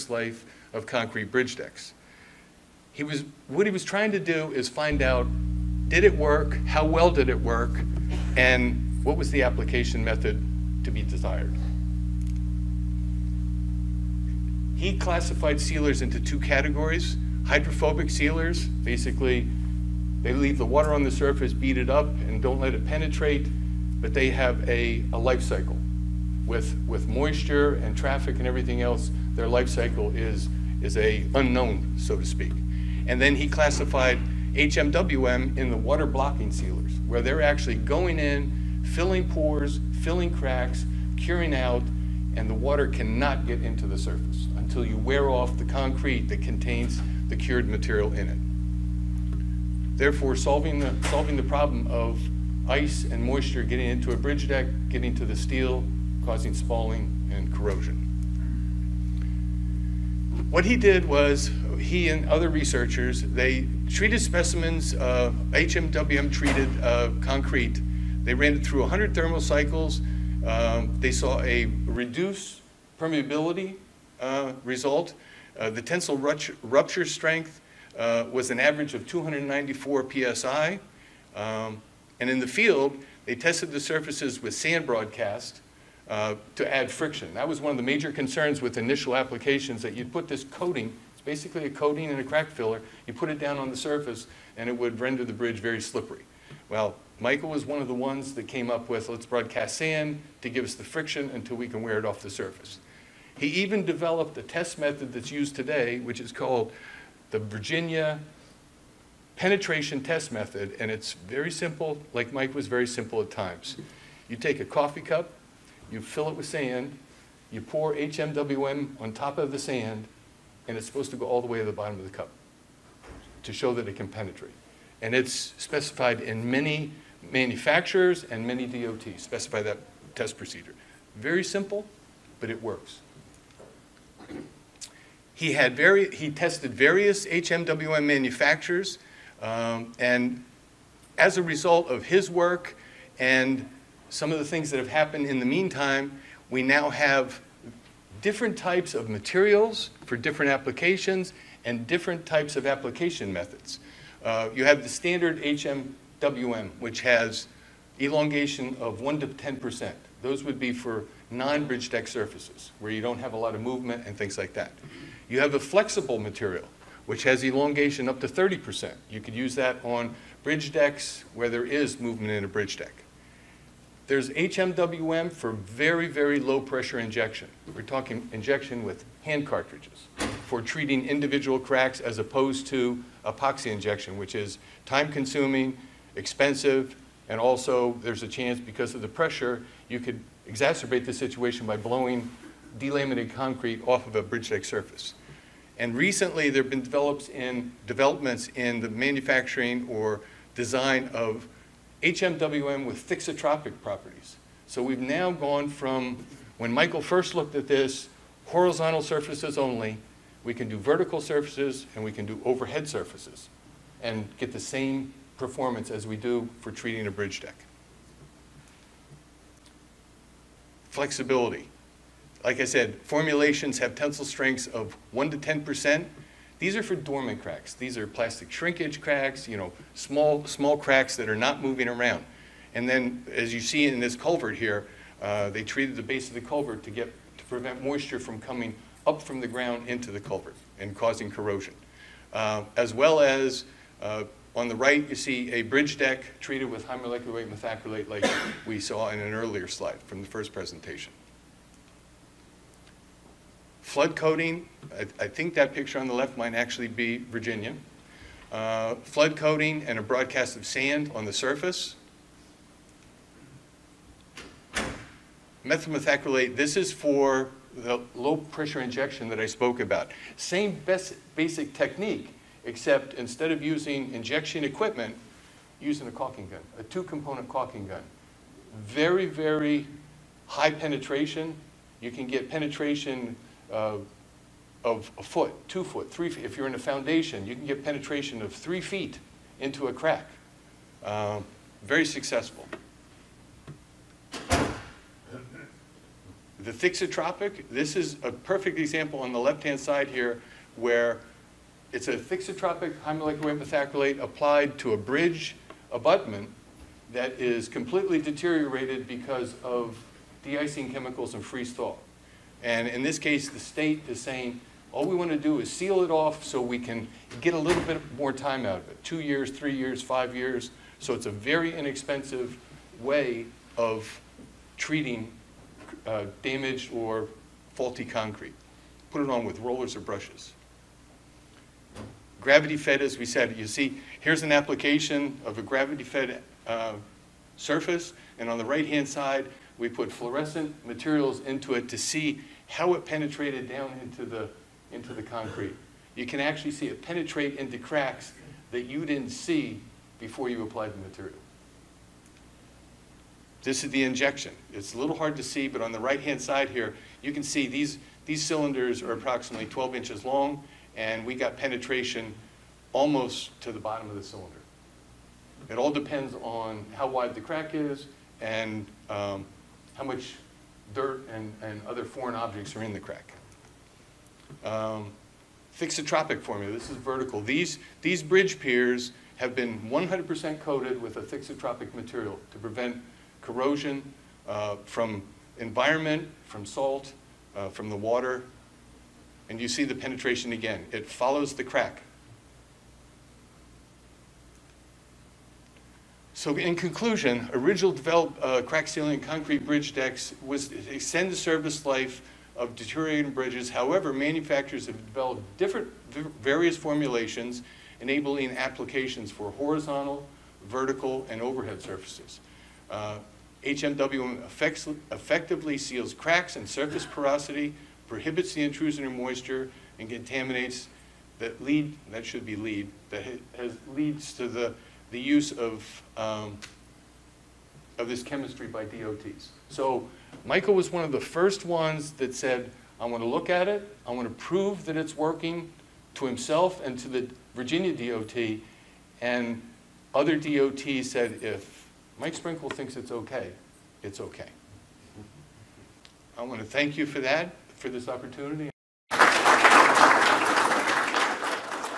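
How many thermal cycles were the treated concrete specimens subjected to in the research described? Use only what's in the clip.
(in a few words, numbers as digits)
100.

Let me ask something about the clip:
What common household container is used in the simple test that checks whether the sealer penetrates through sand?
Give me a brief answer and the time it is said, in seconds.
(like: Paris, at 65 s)
coffee cup, at 114 s.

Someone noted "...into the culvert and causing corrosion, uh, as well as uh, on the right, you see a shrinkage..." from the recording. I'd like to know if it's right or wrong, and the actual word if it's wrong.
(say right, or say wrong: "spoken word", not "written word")
wrong: "bridge", not "shrinkage".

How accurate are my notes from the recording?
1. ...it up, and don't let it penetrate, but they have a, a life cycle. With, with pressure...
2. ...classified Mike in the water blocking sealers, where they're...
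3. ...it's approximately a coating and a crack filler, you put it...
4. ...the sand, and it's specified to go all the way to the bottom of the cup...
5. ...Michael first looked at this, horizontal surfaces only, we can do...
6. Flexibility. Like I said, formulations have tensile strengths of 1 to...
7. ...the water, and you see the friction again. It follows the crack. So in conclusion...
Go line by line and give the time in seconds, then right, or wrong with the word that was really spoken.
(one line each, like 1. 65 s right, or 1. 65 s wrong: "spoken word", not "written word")
1. 21 s wrong: "moisture", not "pressure"
2. 33 s wrong: "HMWM", not "Mike"
3. 91 s wrong: "basically", not "approximately"
4. 119 s wrong: "supposed", not "specified"
5. 206 s right
6. 220 s right
7. 387 s wrong: "penetration", not "friction".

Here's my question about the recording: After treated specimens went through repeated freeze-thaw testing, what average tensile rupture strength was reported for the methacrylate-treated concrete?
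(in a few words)
294 psi.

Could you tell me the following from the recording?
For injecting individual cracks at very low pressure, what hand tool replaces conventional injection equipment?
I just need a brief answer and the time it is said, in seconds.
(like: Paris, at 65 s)
two-component caulking gun, at 276 s.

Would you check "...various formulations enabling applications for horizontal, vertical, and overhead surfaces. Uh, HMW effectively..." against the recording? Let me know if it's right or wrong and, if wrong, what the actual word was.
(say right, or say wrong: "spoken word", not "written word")
right.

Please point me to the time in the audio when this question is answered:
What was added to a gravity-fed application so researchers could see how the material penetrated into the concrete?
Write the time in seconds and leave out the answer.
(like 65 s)
340 s.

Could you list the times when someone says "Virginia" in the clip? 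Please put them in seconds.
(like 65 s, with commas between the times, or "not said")
107 s, 257 s, 437 s.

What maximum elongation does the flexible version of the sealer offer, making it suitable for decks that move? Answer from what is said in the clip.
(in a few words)
30%.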